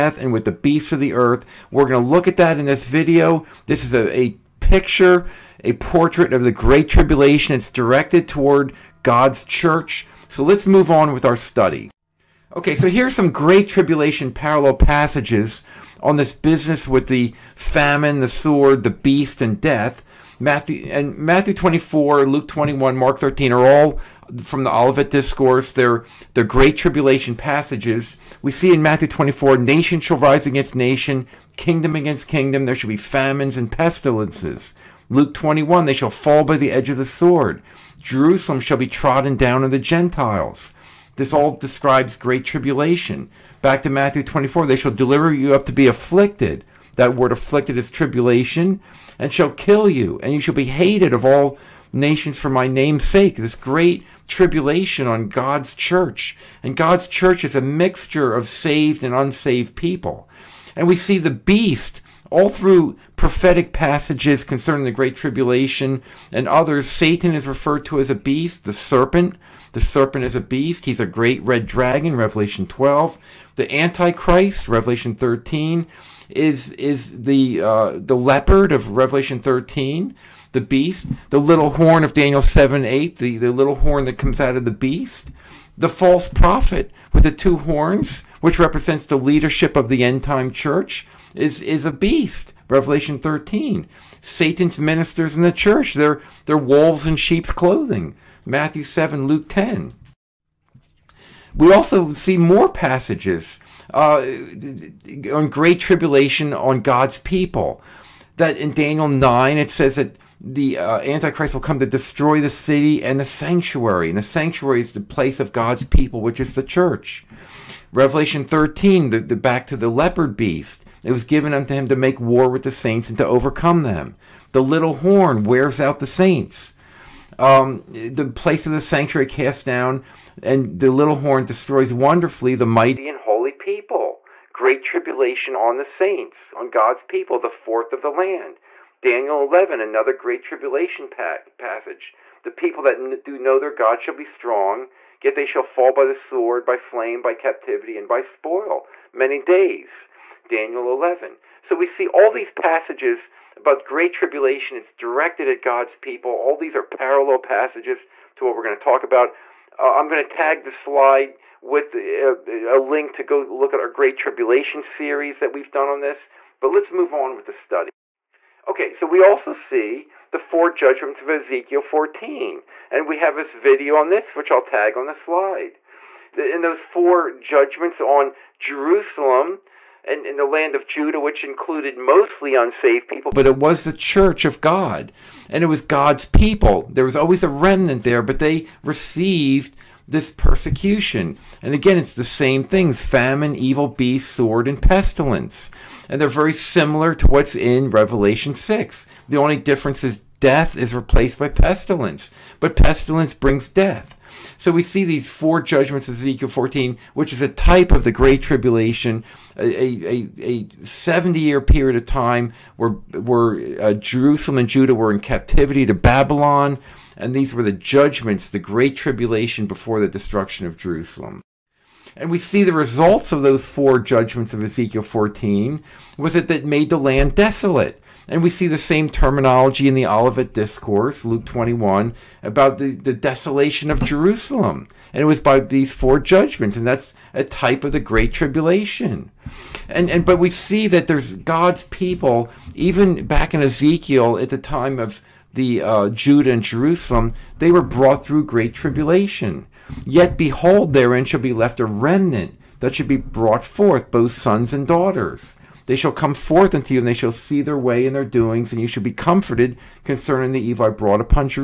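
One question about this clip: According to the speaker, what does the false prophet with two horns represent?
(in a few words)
Leadership of the end time church.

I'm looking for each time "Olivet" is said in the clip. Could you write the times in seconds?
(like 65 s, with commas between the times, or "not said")
24 s, 230 s.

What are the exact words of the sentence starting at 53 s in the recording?
This great tribulation on God's church.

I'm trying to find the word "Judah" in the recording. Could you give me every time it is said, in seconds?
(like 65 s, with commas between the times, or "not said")
180 s, 214 s, 246 s.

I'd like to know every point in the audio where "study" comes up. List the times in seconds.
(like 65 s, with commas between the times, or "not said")
11 s, 167 s.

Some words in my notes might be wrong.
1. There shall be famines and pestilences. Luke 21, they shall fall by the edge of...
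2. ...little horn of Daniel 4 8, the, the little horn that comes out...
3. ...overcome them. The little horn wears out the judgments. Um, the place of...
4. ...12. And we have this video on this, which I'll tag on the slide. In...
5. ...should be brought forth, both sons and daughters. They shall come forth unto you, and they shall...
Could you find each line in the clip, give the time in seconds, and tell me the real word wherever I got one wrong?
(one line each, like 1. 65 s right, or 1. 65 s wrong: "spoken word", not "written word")
1. 32 s right
2. 81 s wrong: "7", not "4"
3. 123 s wrong: "saints", not "judgments"
4. 171 s wrong: "14", not "12"
5. 252 s right.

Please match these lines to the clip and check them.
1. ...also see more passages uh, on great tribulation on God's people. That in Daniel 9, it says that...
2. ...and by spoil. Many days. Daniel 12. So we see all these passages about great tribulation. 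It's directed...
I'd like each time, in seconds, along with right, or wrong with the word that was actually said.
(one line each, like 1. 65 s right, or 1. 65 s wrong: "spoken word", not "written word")
1. 101 s right
2. 147 s wrong: "11", not "12".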